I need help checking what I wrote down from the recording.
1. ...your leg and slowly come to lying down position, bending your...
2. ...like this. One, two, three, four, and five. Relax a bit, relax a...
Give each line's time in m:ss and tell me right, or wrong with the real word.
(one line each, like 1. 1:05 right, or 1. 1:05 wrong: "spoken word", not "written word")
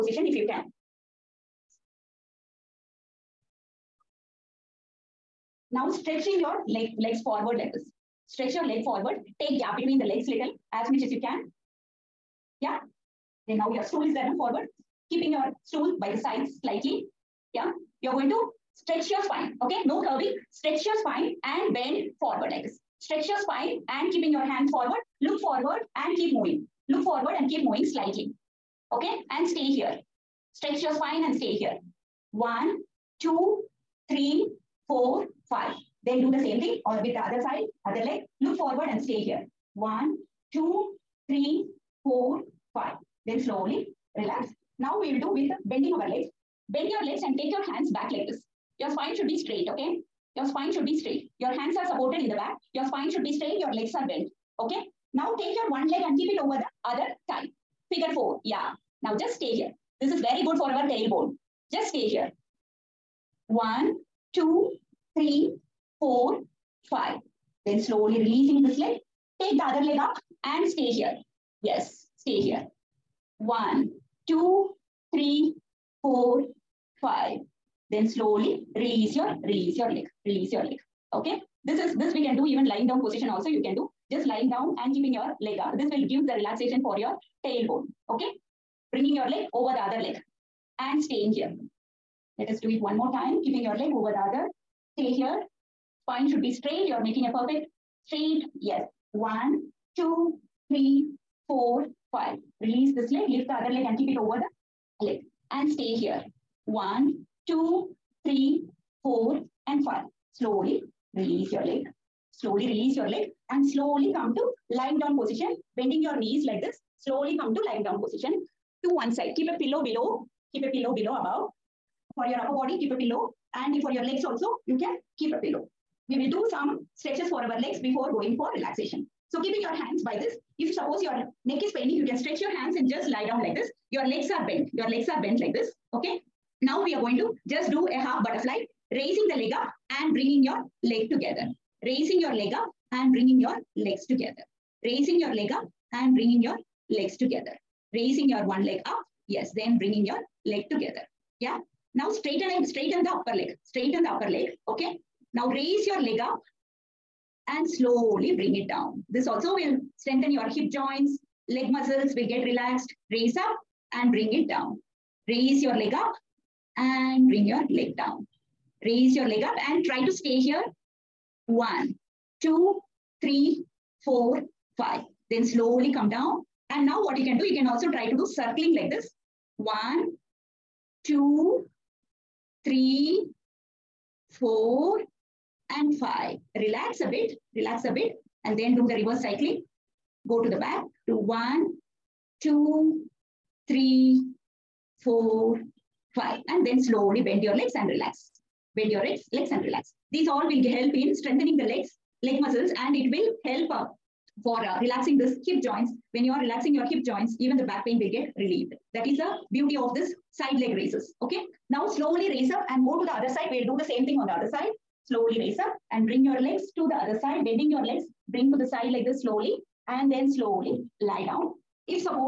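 1. 1:52 right
2. 2:58 right.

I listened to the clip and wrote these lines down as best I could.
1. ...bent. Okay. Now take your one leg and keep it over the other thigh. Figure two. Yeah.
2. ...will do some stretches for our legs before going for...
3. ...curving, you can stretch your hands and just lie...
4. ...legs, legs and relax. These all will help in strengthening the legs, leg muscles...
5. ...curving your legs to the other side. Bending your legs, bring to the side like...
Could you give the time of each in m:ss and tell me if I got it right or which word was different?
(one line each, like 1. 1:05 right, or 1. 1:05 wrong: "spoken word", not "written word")
1. 0:54 wrong: "four", not "two"
2. 2:06 right
3. 2:11 wrong: "paining", not "curving"
4. 3:19 right
5. 3:36 wrong: "bring", not "curving".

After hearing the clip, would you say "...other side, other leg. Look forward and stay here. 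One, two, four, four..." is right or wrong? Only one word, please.
wrong.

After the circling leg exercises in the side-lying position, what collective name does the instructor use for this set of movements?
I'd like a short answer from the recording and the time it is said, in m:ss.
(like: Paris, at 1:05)
Side leg raises, at 3:30.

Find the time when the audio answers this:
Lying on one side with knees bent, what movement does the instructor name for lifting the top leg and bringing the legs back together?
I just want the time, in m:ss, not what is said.
2:18.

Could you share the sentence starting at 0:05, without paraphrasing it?
Now stretching your leg, legs forward like this.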